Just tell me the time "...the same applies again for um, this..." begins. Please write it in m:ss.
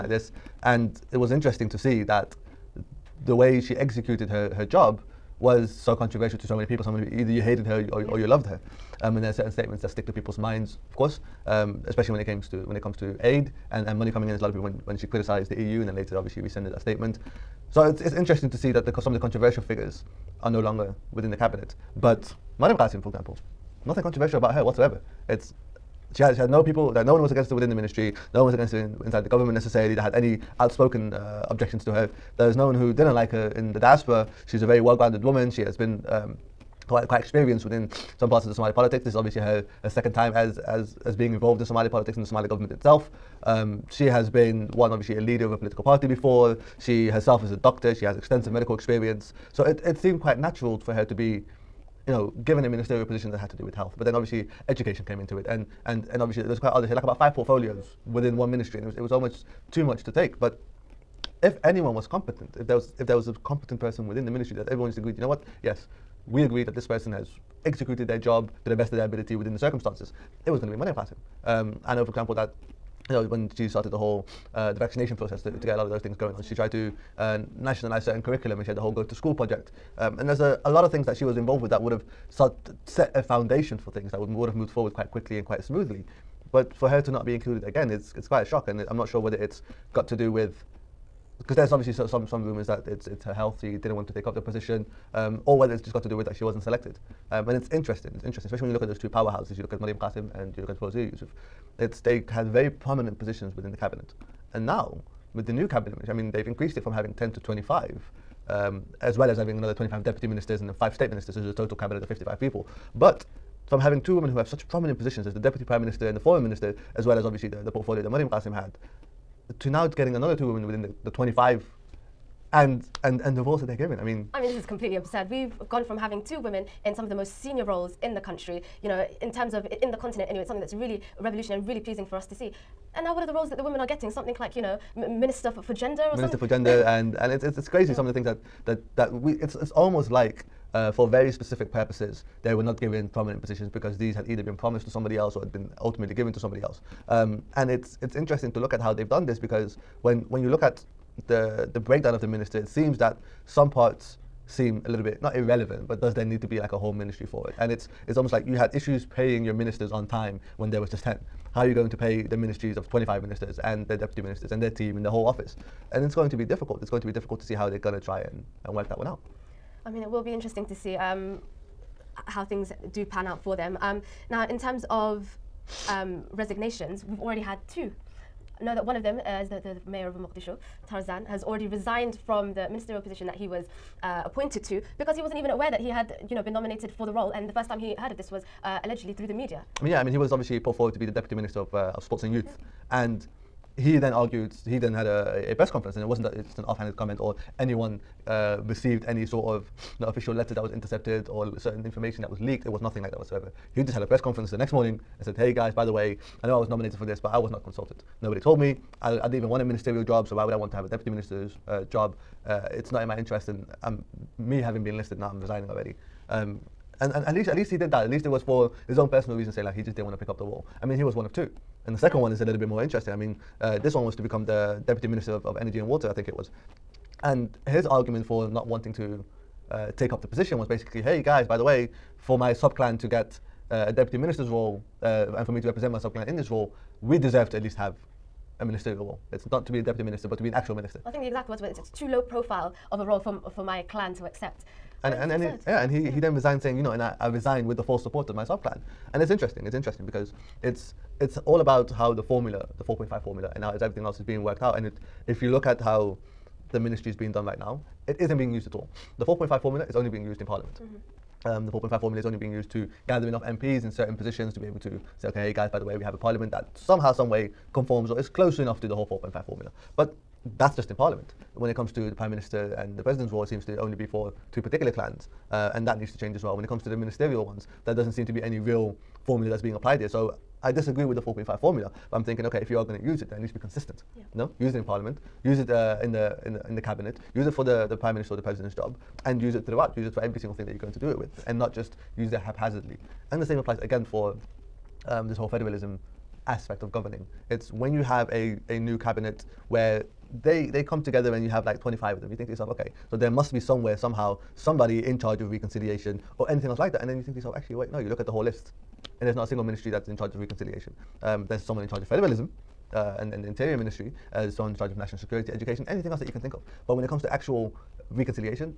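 4:53.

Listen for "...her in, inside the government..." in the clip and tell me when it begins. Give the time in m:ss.
0:28.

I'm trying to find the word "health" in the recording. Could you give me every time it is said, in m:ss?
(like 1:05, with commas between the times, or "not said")
0:53, 1:33.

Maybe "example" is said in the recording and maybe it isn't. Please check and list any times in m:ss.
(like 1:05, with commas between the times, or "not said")
0:23, 1:12.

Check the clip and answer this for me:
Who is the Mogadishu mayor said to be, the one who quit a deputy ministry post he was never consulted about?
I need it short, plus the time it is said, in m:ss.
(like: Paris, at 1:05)
Tarzan, at 3:00.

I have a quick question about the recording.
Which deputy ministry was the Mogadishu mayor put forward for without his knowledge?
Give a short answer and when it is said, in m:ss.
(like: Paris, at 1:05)
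Sports and youth, at 3:12.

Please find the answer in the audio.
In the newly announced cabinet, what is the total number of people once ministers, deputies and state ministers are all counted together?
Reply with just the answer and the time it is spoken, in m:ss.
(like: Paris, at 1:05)
55, at 1:52.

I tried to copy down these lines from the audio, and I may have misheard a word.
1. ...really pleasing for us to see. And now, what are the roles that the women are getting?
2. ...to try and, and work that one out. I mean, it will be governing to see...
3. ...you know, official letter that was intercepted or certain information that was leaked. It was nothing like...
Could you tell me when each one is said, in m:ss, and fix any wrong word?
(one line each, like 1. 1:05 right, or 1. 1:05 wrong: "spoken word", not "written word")
1. 2:11 right
2. 2:47 wrong: "interesting", not "governing"
3. 3:19 right.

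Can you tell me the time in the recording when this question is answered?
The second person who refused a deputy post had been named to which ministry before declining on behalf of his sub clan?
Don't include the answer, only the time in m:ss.
3:45.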